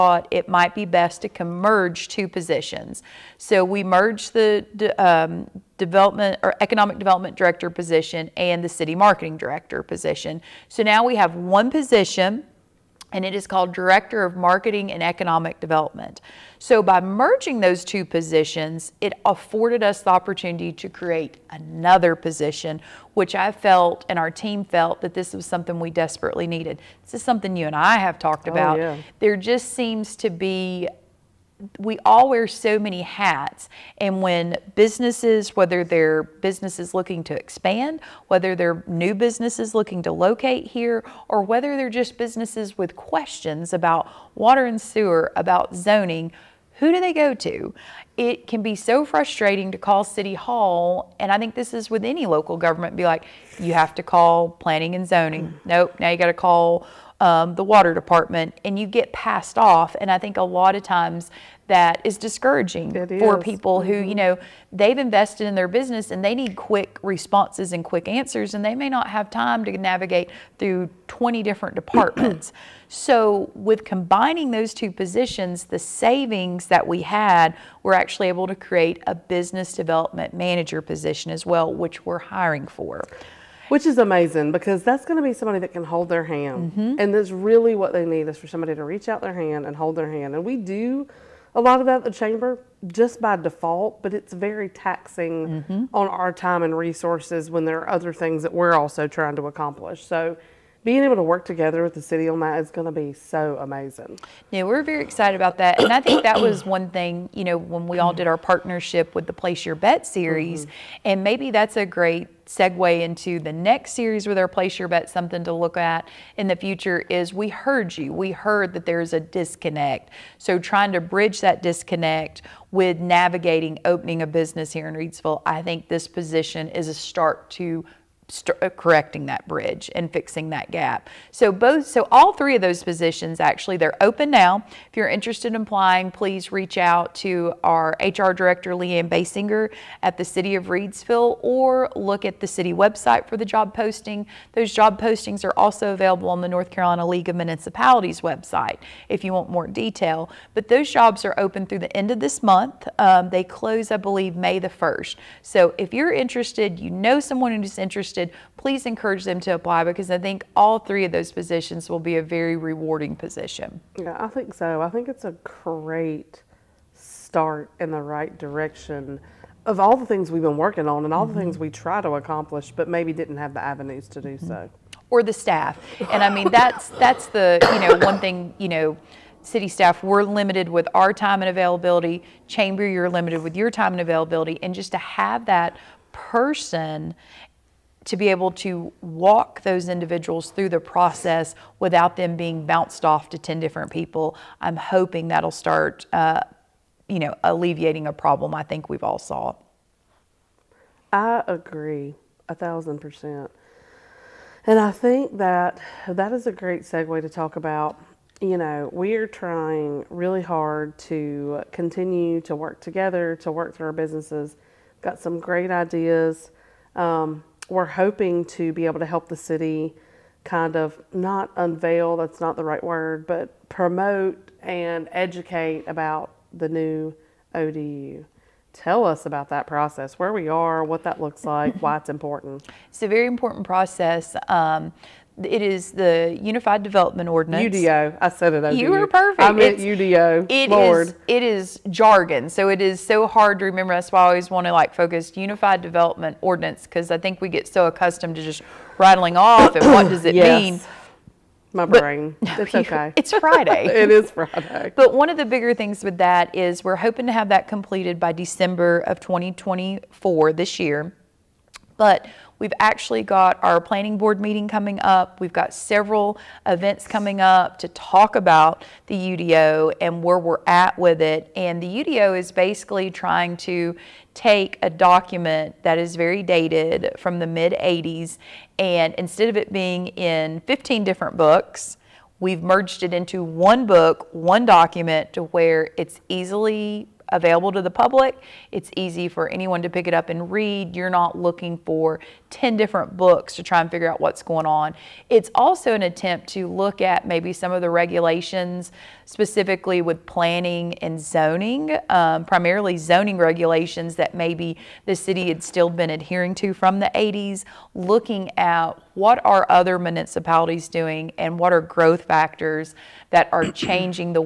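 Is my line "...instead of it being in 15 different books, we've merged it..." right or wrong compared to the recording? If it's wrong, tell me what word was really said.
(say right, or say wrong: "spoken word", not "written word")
right.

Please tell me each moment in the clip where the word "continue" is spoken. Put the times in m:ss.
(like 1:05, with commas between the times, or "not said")
3:31.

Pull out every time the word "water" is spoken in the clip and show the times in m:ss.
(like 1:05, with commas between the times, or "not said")
0:44, 0:57.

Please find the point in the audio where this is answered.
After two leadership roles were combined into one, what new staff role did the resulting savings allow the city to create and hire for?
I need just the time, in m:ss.
1:19.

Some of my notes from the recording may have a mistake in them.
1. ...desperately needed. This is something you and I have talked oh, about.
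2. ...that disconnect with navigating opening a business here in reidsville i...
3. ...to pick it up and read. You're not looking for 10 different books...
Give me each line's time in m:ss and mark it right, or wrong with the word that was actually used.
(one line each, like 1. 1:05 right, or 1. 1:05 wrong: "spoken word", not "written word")
1. 0:25 right
2. 2:01 right
3. 4:49 right.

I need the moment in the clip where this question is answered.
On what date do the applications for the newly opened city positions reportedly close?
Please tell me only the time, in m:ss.
2:34.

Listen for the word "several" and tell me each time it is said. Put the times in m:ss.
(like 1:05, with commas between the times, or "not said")
4:25.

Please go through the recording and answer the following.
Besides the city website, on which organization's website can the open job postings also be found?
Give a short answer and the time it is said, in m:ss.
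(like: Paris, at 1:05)
North Carolina League of Municipalities, at 2:26.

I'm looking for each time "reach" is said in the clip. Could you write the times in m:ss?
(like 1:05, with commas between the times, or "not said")
1:28, 2:16.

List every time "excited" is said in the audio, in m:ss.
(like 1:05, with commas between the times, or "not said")
1:45.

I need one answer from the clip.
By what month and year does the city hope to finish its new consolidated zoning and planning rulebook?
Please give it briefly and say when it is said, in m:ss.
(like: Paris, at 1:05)
December 2024, at 4:18.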